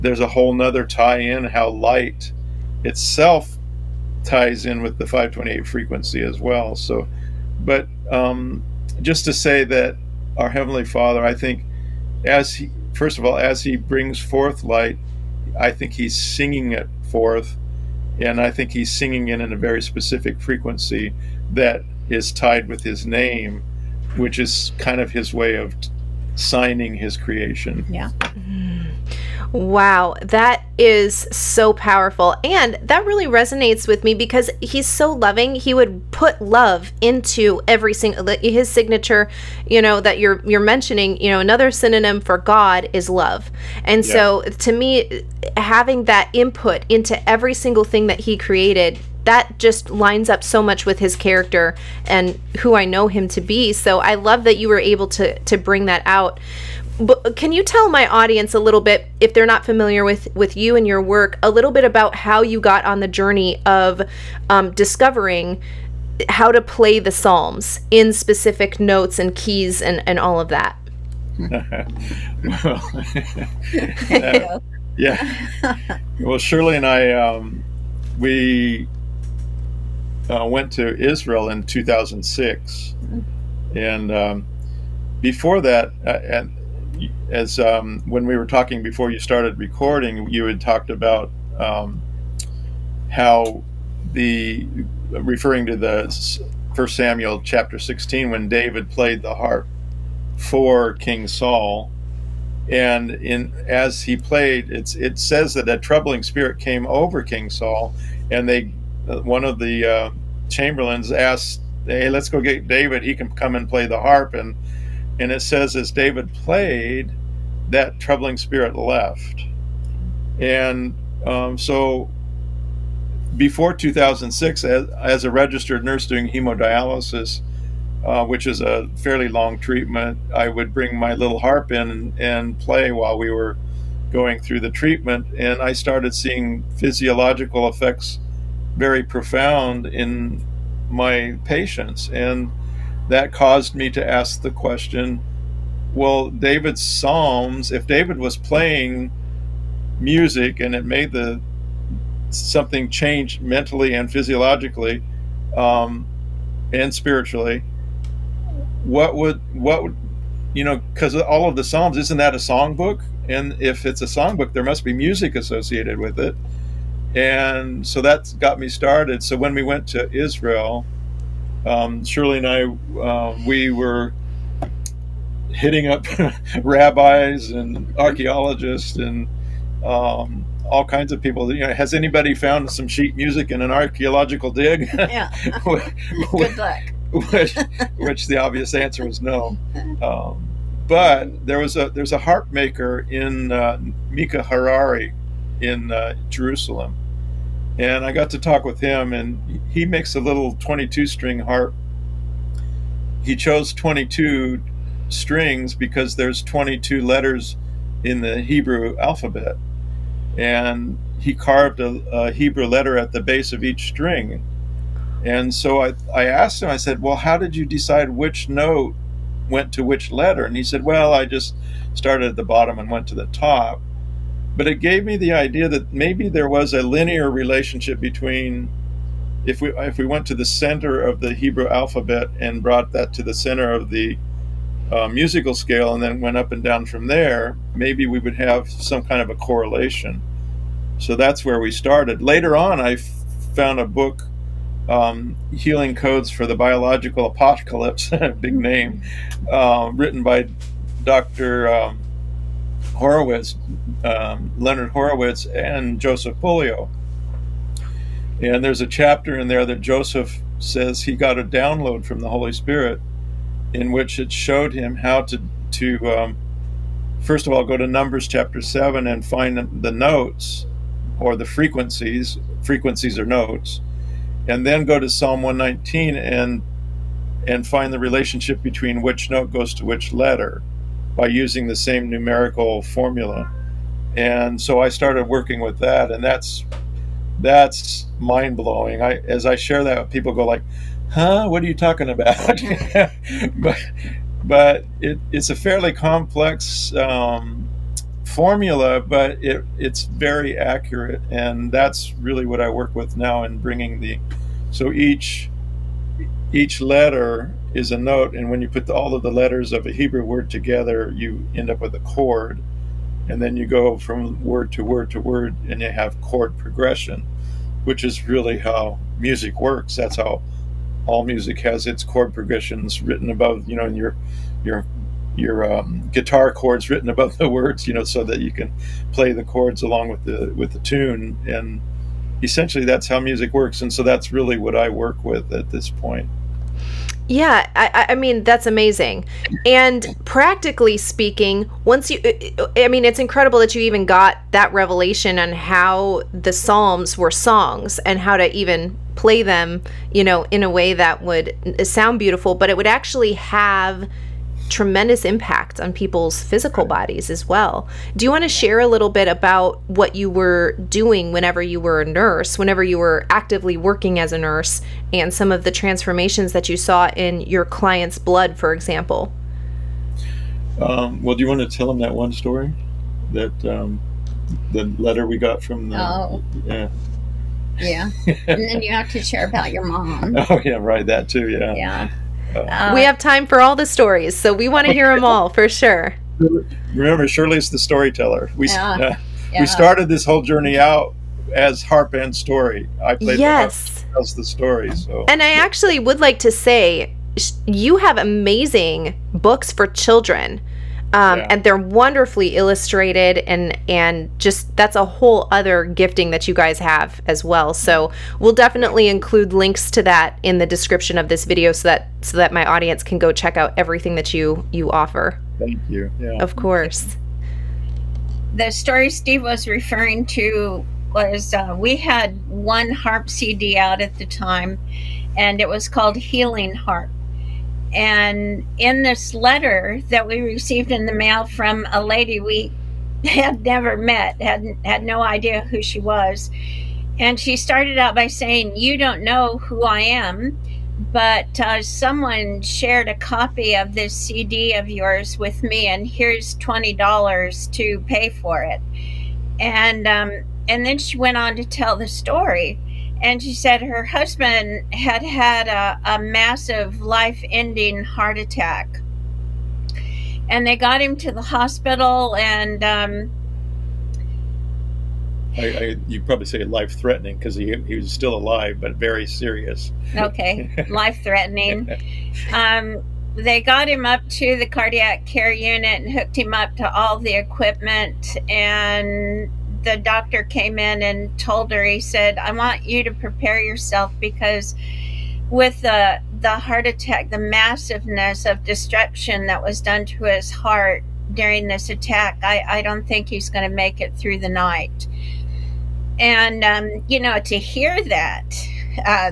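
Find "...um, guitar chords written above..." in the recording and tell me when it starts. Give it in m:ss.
5:25.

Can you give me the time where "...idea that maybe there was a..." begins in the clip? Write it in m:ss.
3:45.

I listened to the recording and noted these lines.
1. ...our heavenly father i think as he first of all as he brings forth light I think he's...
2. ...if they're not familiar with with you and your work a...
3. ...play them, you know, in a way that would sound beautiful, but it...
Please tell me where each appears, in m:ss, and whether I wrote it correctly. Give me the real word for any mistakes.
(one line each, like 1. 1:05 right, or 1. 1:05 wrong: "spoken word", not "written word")
1. 0:10 right
2. 0:59 right
3. 5:49 right.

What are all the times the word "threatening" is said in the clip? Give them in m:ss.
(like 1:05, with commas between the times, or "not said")
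7:46, 7:51.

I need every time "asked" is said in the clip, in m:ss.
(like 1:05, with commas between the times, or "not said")
1:51, 3:36.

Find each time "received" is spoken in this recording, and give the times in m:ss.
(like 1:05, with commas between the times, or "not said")
7:10.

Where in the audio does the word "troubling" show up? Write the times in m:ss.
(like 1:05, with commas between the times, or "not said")
1:45, 1:57.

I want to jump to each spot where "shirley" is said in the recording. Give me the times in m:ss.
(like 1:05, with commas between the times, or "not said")
1:16, 2:52, 6:27.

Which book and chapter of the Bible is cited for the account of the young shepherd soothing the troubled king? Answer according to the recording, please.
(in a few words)
First Samuel 16.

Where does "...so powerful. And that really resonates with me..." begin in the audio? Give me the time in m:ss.
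0:31.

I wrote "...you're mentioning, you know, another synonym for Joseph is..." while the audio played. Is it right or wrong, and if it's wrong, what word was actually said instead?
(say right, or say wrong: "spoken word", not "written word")
wrong: "God", not "Joseph".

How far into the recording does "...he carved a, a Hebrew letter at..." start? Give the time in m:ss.
3:31.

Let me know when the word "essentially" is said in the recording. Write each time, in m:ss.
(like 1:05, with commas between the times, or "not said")
5:32.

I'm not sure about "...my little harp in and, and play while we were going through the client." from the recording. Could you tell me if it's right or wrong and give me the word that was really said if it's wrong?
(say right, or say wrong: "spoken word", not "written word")
wrong: "treatment", not "client".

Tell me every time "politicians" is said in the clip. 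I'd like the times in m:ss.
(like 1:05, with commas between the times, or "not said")
not said.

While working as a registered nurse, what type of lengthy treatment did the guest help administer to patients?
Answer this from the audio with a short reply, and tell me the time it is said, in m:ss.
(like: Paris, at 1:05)
hemodialysis, at 2:06.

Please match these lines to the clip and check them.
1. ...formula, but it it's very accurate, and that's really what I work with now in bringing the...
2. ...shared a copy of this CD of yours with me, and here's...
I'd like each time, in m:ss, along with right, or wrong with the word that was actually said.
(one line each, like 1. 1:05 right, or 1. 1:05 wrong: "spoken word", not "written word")
1. 4:58 right
2. 7:22 right.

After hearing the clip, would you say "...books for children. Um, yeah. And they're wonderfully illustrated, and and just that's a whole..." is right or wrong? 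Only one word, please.
right.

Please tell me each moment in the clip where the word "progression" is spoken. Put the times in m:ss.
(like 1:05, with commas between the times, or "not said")
5:16, 5:22.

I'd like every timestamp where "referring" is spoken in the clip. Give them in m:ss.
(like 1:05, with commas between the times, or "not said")
1:35, 6:59.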